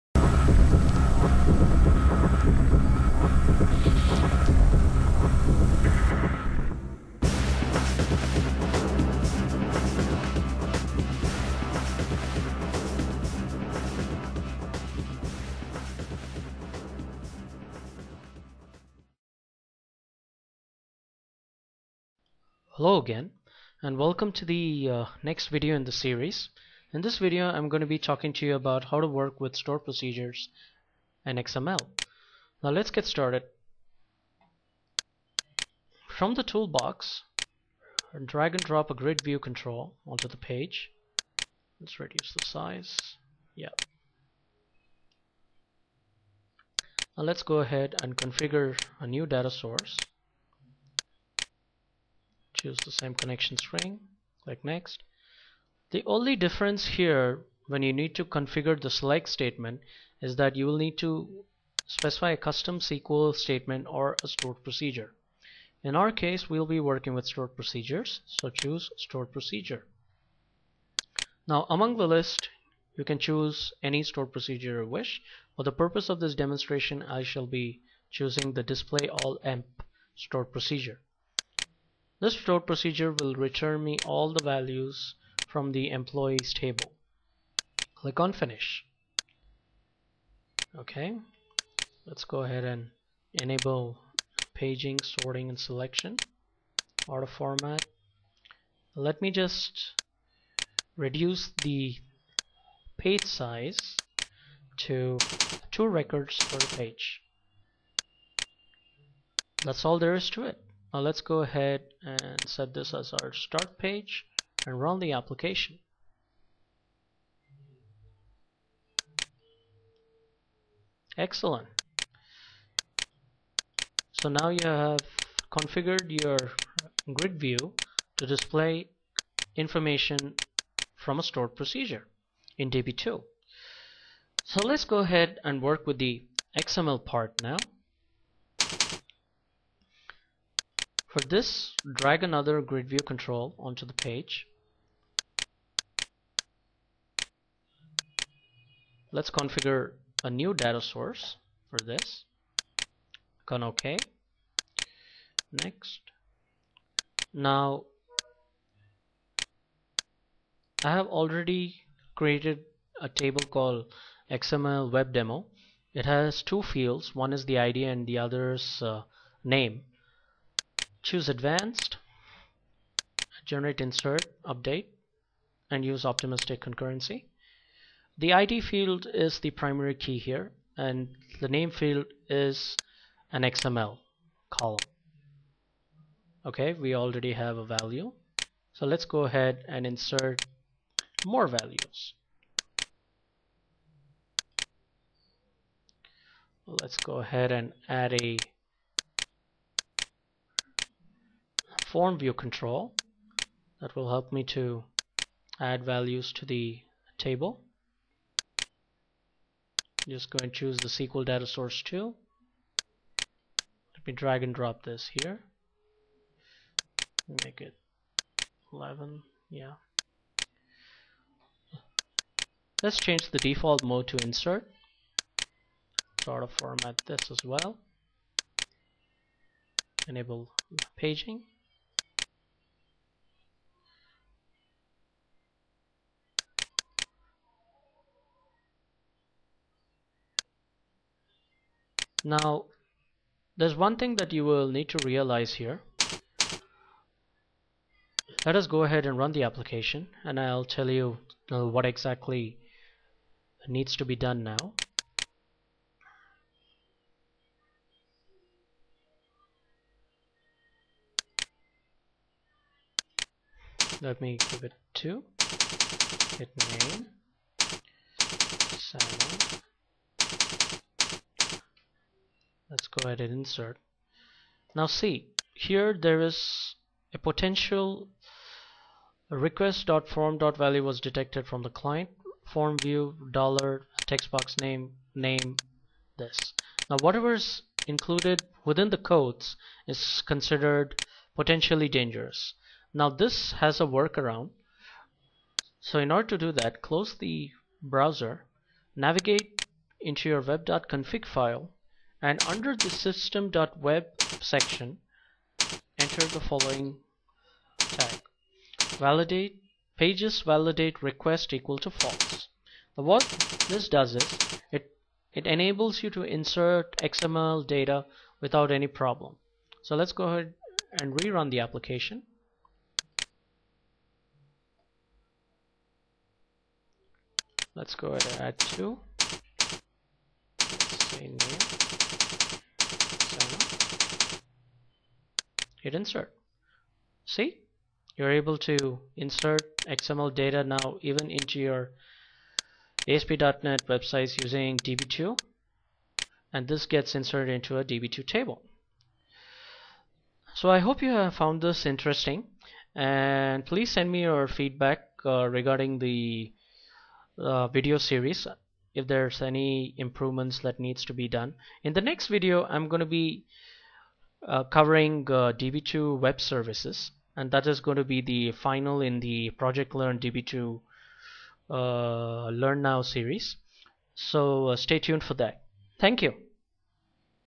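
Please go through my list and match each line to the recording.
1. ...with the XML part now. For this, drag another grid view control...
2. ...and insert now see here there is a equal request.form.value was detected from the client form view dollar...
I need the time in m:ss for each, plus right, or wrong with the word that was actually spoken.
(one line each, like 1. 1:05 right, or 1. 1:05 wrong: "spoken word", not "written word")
1. 2:15 right
2. 4:33 wrong: "potential", not "equal".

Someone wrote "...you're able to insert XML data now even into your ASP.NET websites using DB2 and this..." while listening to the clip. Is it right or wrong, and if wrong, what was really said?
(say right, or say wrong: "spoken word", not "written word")
right.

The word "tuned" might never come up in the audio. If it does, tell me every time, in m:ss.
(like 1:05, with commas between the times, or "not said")
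6:14.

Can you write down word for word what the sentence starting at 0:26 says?
In this video I'm going to be talking to you about how to work with store procedures and XML.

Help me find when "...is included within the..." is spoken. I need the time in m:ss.
4:47.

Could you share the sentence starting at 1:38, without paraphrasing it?
Let me just reduce the page size to two records per page.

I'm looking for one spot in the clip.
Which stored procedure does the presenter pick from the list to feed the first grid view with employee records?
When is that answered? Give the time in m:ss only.
1:18.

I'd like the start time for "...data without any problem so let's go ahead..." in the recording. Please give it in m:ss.
5:17.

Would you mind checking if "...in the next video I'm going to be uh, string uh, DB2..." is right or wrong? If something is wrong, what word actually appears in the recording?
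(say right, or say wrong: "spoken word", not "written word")
wrong: "covering", not "string".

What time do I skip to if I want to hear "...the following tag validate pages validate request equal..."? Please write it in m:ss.
5:06.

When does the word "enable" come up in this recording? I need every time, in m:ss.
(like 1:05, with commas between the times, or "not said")
1:33, 3:50, 5:15.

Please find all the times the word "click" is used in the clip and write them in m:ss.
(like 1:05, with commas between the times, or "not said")
0:54, 1:27, 2:33.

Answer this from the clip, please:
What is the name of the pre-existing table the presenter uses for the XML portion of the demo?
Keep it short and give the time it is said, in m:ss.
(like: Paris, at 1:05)
XML web demo, at 2:44.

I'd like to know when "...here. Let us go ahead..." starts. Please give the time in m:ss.
4:05.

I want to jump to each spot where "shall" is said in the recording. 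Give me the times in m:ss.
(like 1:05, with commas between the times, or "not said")
1:17.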